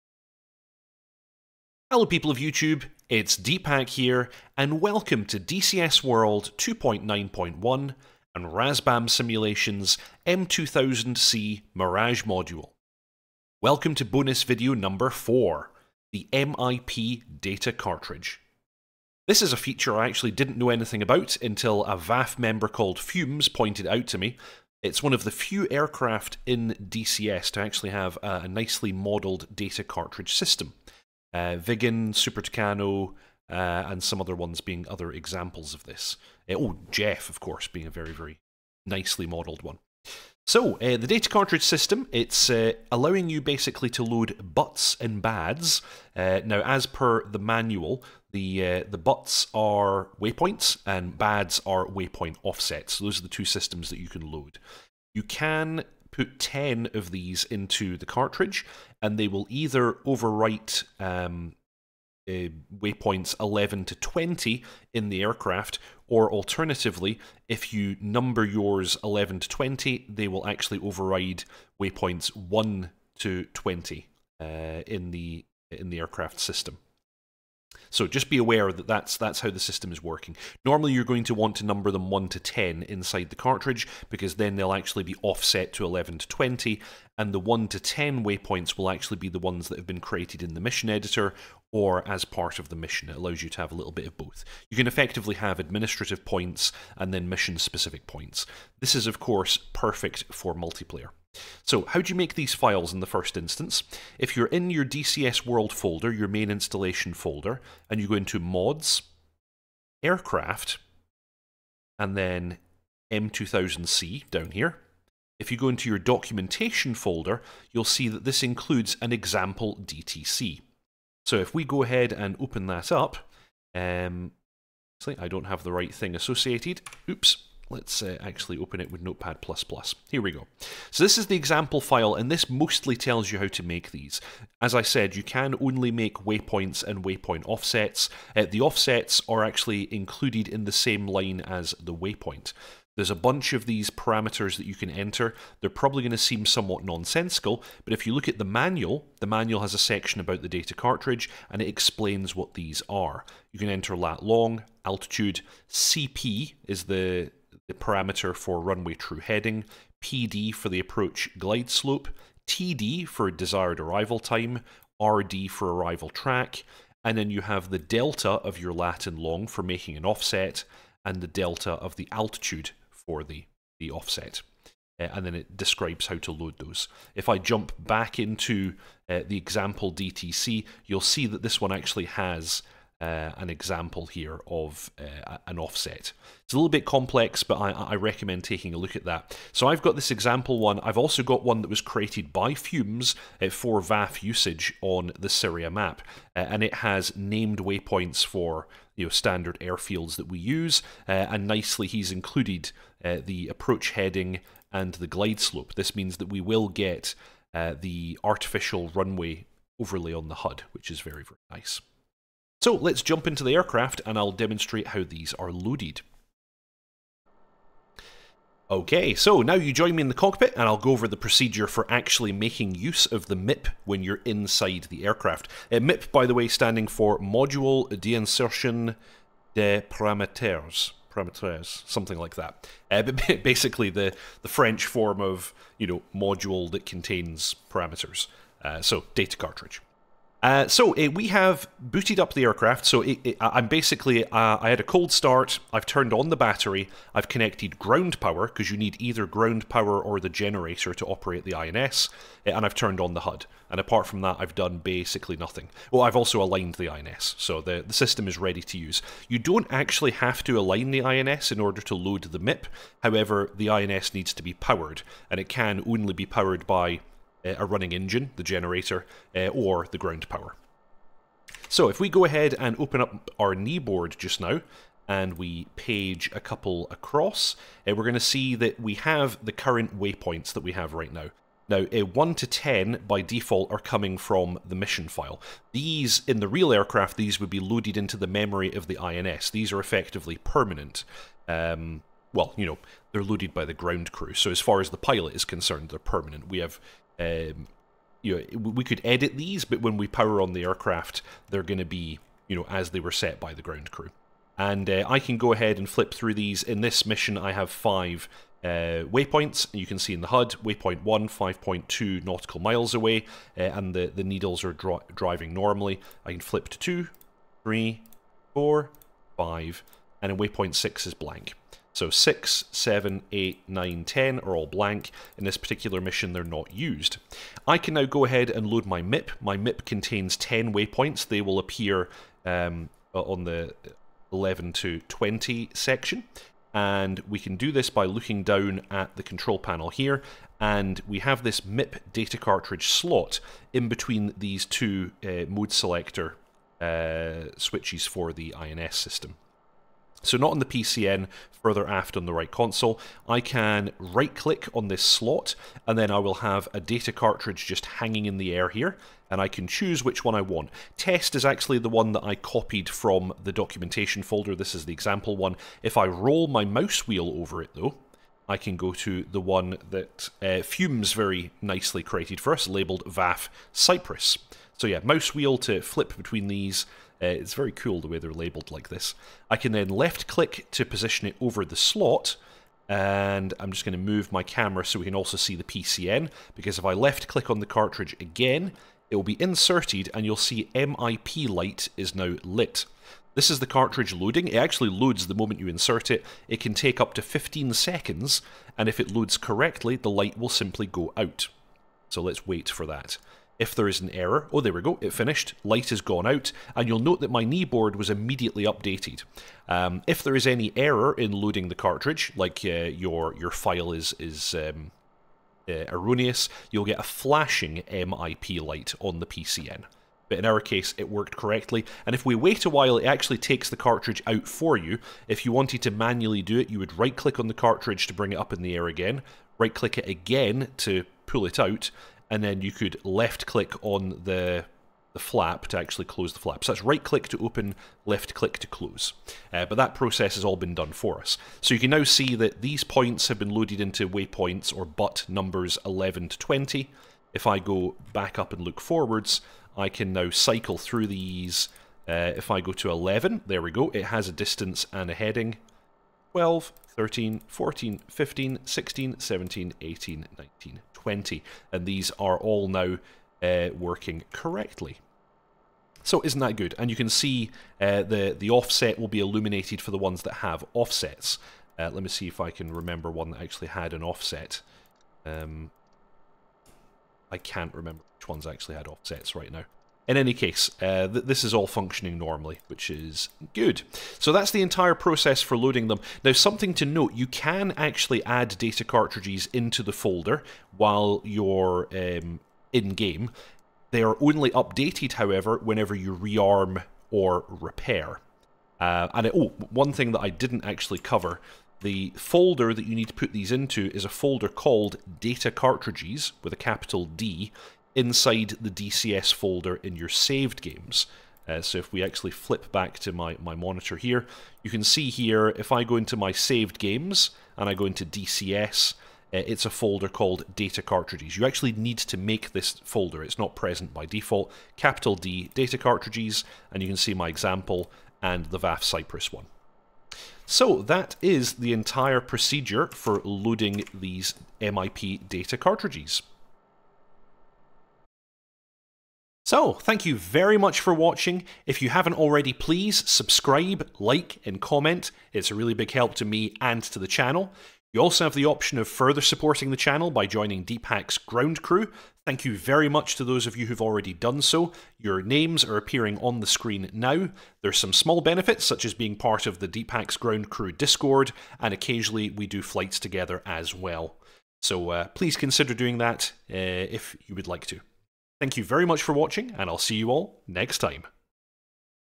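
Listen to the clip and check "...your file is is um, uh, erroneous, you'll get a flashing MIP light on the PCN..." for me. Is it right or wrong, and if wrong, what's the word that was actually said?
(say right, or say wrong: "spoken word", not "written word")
right.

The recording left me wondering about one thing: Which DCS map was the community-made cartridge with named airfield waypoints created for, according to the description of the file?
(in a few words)
Syria.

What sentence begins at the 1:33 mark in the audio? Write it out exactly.
It allows you to have a little bit of both.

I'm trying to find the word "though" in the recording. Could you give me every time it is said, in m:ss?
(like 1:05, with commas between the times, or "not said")
6:07.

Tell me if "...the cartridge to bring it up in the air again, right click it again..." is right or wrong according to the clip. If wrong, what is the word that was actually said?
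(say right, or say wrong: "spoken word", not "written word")
right.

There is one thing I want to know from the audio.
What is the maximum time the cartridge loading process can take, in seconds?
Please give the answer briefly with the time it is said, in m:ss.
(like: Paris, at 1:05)
15 seconds, at 6:37.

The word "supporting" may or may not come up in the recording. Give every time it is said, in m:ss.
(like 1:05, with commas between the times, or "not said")
9:09.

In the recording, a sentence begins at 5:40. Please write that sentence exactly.
And we have this MIP data cartridge slot in between these two uh, mode selector uh, switches for the INS system.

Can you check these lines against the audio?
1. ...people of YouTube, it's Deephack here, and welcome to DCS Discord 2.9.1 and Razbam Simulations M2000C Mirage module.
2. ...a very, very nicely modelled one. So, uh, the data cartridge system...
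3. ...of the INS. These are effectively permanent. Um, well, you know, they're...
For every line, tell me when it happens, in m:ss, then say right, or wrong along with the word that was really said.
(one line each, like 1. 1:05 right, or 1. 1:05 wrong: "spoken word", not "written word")
1. 0:02 wrong: "World", not "Discord"
2. 0:37 right
3. 4:48 right.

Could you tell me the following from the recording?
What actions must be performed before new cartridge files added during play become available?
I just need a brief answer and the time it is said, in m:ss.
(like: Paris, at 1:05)
rearm or repair, at 8:16.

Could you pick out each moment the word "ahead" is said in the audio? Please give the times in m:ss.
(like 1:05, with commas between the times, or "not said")
2:01, 4:32, 5:05, 5:28.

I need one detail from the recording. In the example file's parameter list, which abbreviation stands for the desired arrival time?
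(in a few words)
TD.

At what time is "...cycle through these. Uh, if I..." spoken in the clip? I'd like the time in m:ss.
7:30.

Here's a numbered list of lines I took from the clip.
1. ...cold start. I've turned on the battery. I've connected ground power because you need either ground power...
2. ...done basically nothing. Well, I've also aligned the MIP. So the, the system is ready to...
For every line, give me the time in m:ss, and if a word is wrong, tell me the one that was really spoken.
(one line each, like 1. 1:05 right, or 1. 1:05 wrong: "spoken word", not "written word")
1. 4:04 right
2. 4:14 wrong: "INS", not "MIP".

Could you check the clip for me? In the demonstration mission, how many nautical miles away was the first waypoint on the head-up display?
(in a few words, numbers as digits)
5.2.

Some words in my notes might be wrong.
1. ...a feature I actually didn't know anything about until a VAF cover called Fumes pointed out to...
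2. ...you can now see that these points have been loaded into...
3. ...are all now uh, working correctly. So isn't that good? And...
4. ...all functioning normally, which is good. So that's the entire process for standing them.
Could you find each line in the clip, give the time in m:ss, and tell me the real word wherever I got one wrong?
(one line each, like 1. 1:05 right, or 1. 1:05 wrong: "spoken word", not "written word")
1. 0:19 wrong: "member", not "cover"
2. 7:21 right
3. 7:42 right
4. 8:01 wrong: "loading", not "standing".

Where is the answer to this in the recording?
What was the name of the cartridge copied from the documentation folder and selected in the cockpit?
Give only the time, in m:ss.
6:00.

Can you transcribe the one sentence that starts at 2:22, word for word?
There's a bunch of these parameters that you can enter.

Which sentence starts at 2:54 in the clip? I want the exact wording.
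Uh, and then it describes how to load those.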